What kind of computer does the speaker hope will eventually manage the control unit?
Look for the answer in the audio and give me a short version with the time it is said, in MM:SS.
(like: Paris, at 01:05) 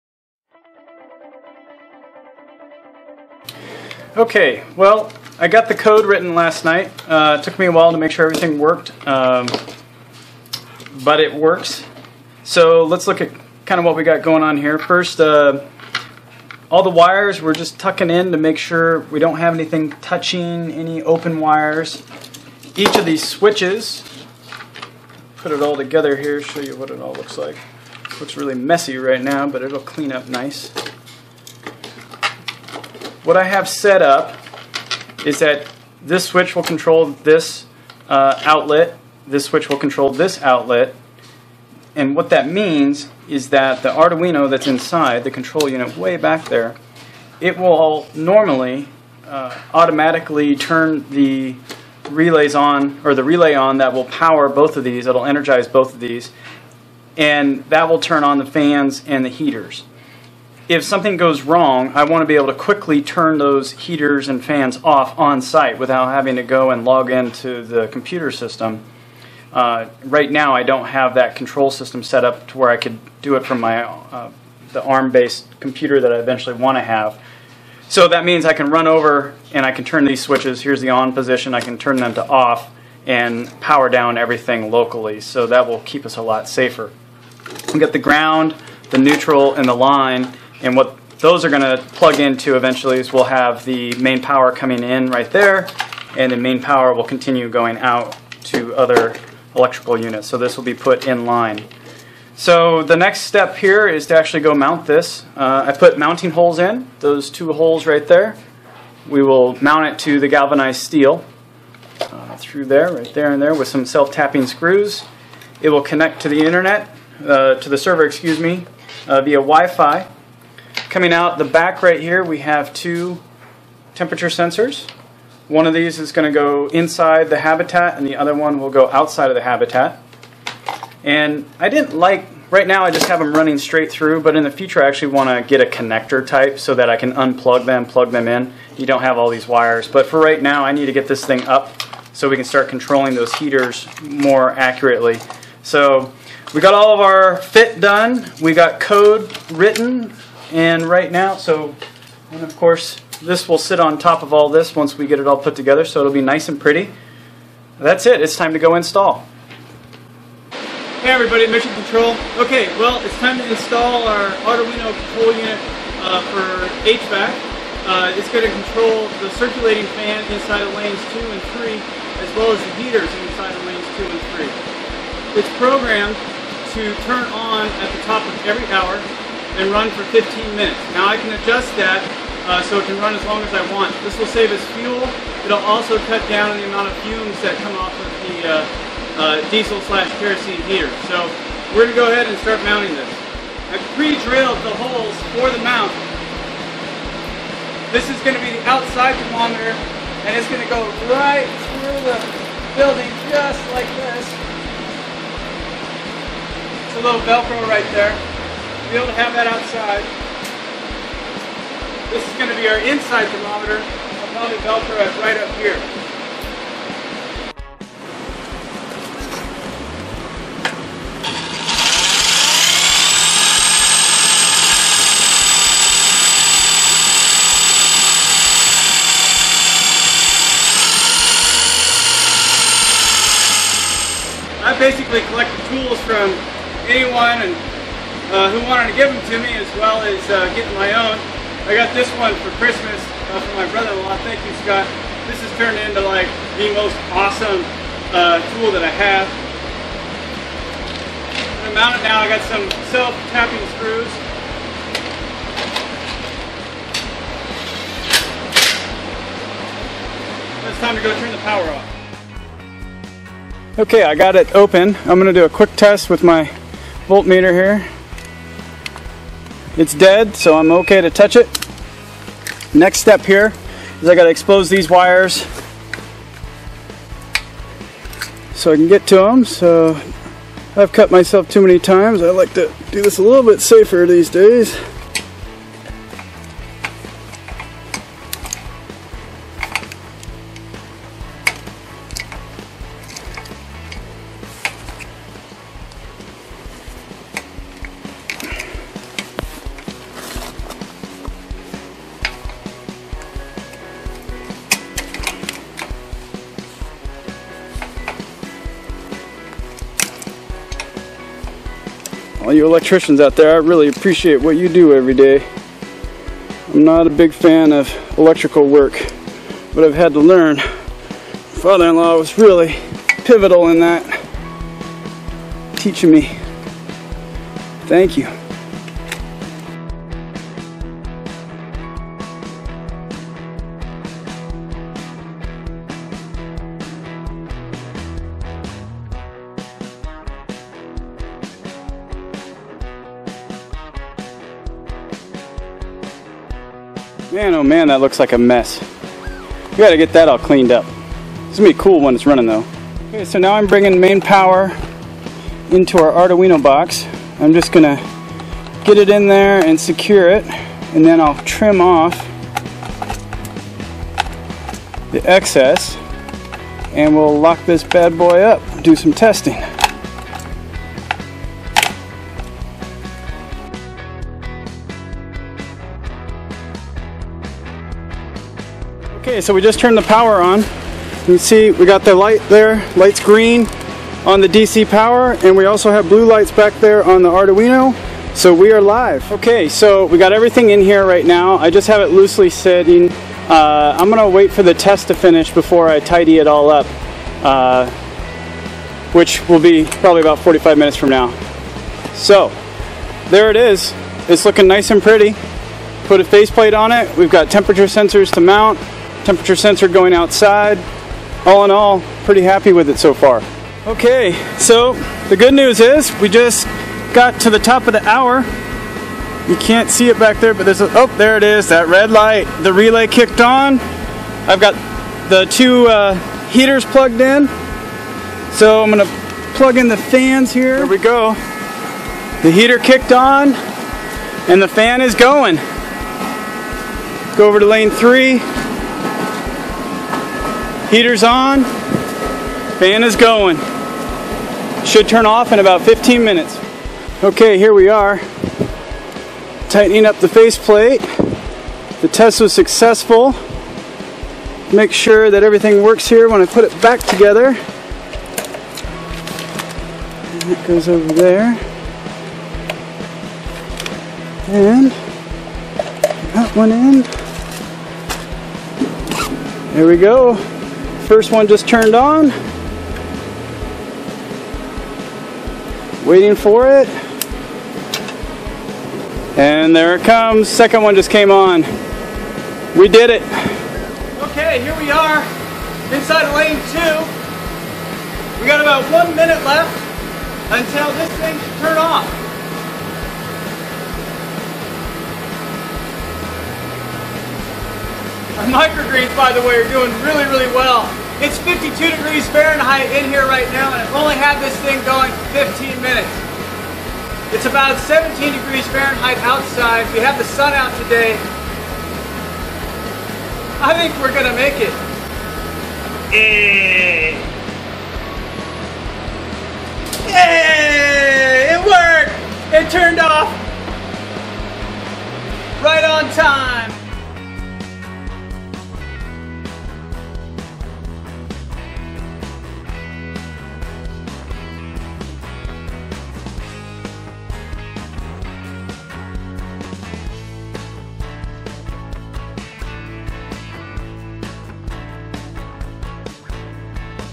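ARM-based computer, at 01:14.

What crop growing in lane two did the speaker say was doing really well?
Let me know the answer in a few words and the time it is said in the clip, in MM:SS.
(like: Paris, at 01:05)
microgreens, at 08:18.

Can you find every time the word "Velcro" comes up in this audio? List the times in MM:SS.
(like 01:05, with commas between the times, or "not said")
03:27, 03:34.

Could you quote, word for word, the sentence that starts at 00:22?
Each of these switches, put it all together here, show you what it all looks like.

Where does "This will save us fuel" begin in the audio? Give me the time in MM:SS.
03:04.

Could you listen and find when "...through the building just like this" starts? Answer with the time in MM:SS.
03:21.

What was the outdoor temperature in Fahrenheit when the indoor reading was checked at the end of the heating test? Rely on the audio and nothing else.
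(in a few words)
17 degrees.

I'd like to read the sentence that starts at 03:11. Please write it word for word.
So we're going to go ahead and start mounting this.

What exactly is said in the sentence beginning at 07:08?
So I'm gonna plug in the fans here.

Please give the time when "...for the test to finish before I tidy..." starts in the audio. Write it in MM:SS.
06:34.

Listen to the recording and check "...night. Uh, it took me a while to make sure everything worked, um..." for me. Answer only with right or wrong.
right.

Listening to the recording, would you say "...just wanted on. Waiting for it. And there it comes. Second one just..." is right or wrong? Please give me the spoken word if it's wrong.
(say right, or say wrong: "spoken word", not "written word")
wrong: "turned", not "wanted".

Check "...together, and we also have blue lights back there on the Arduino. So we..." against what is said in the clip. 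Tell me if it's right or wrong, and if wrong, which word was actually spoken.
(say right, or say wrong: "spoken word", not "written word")
wrong: "power", not "together".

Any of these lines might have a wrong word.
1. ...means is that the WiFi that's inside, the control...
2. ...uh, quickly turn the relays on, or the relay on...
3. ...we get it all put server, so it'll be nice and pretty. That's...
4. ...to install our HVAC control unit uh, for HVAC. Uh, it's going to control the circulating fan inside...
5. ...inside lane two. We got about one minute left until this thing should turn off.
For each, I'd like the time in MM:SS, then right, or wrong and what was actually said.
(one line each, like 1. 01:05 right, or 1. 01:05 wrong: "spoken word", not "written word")
1. 00:42 wrong: "Arduino", not "WiFi"
2. 00:49 wrong: "automatically", not "quickly"
3. 02:34 wrong: "together", not "server"
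4. 02:43 wrong: "Arduino", not "HVAC"
5. 08:05 right.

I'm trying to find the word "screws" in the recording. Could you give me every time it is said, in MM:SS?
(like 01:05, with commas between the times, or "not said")
01:54, 04:13.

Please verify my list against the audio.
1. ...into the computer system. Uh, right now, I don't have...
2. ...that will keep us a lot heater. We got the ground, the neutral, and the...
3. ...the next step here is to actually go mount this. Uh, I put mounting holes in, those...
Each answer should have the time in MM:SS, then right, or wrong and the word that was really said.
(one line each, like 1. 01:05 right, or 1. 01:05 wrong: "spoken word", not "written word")
1. 01:07 right
2. 01:25 wrong: "safer", not "heater"
3. 01:42 right.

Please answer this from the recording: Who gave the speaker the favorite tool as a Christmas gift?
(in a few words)
Scott.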